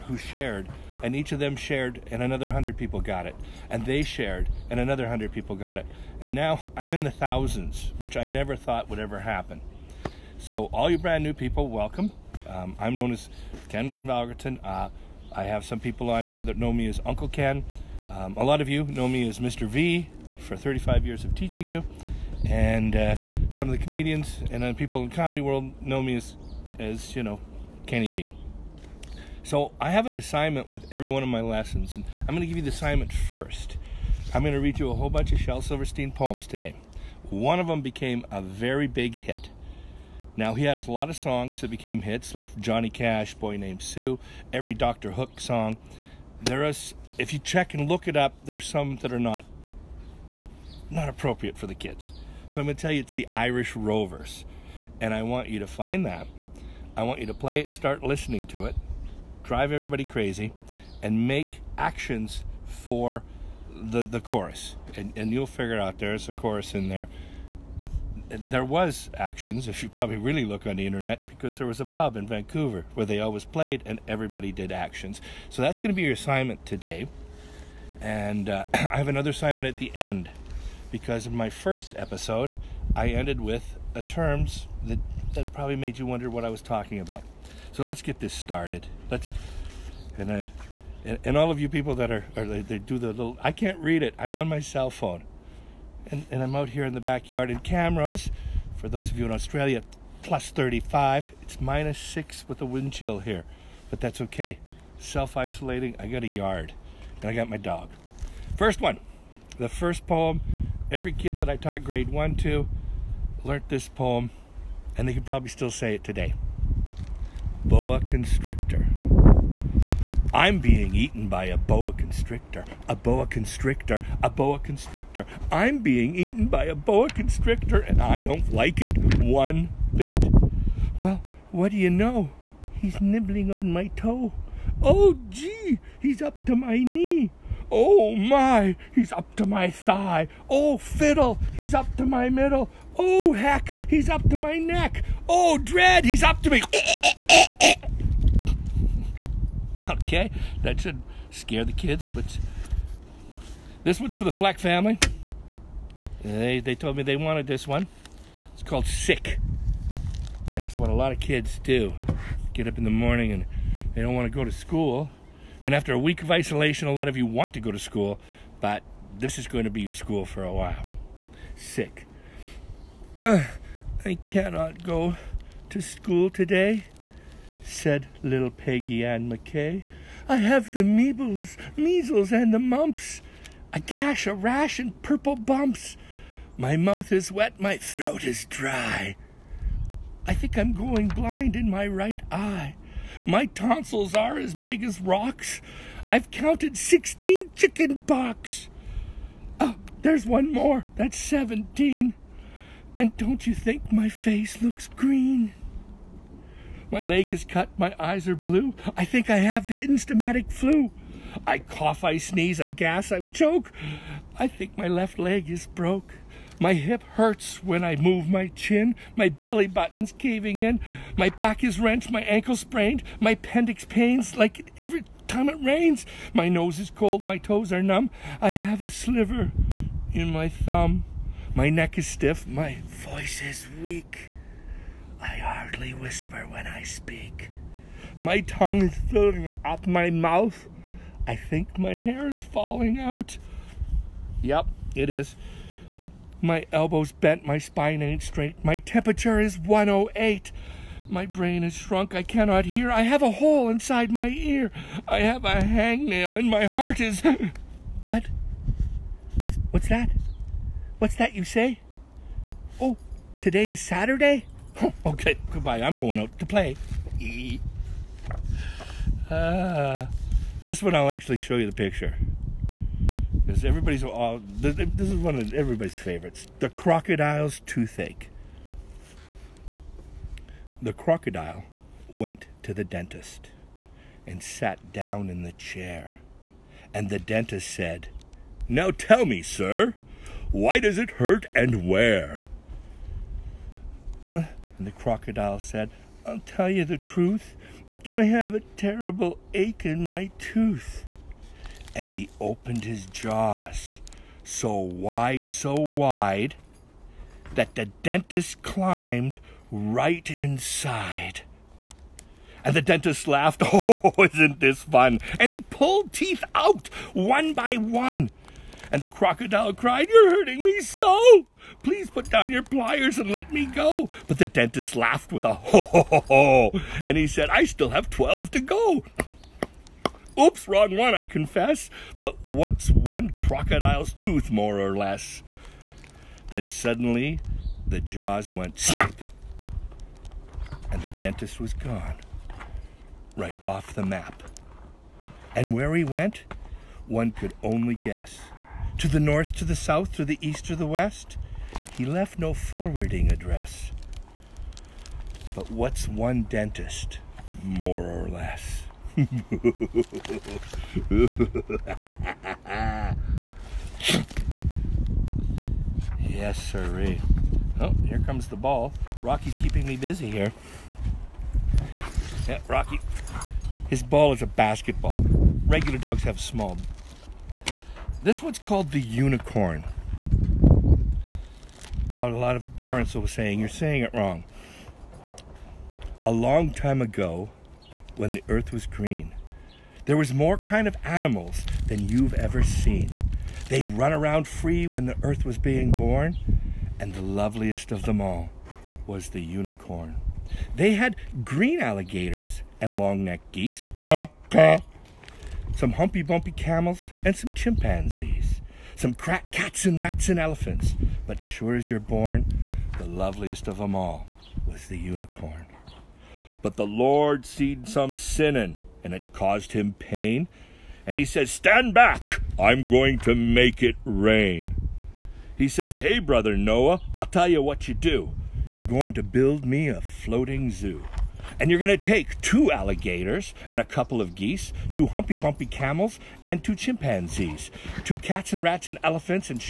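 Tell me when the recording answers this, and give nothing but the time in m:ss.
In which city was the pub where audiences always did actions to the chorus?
1:12.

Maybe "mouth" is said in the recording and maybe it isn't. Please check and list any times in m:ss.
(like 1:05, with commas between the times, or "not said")
3:06, 4:00.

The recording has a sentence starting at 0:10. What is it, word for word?
So, all you brand new people, welcome.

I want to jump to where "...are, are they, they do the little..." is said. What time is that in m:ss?
1:32.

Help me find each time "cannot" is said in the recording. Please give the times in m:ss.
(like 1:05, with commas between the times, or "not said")
2:54, 4:12.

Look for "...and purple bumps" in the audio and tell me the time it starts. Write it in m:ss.
3:04.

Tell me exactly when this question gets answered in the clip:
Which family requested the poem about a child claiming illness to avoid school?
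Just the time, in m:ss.
2:34.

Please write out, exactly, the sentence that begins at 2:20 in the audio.
Oh fiddle, he's up to my middle.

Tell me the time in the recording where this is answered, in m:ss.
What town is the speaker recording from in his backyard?
1:37.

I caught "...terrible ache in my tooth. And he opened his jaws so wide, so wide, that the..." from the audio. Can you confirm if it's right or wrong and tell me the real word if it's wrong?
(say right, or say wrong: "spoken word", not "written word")
right.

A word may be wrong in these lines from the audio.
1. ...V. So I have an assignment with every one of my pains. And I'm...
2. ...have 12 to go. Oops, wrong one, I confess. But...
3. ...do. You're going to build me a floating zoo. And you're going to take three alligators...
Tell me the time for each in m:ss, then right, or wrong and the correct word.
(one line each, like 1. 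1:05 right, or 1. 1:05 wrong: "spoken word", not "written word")
1. 0:28 wrong: "lessons", not "pains"
2. 5:27 right
3. 7:07 wrong: "two", not "three".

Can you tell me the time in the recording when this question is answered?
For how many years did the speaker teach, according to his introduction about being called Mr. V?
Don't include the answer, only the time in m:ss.
0:20.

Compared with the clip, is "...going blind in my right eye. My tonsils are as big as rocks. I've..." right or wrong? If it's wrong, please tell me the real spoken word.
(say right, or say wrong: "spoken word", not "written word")
right.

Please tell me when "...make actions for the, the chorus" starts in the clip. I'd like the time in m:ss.
1:01.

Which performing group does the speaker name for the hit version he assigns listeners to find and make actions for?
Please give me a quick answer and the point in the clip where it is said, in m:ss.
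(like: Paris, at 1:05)
Irish Rovers, at 0:53.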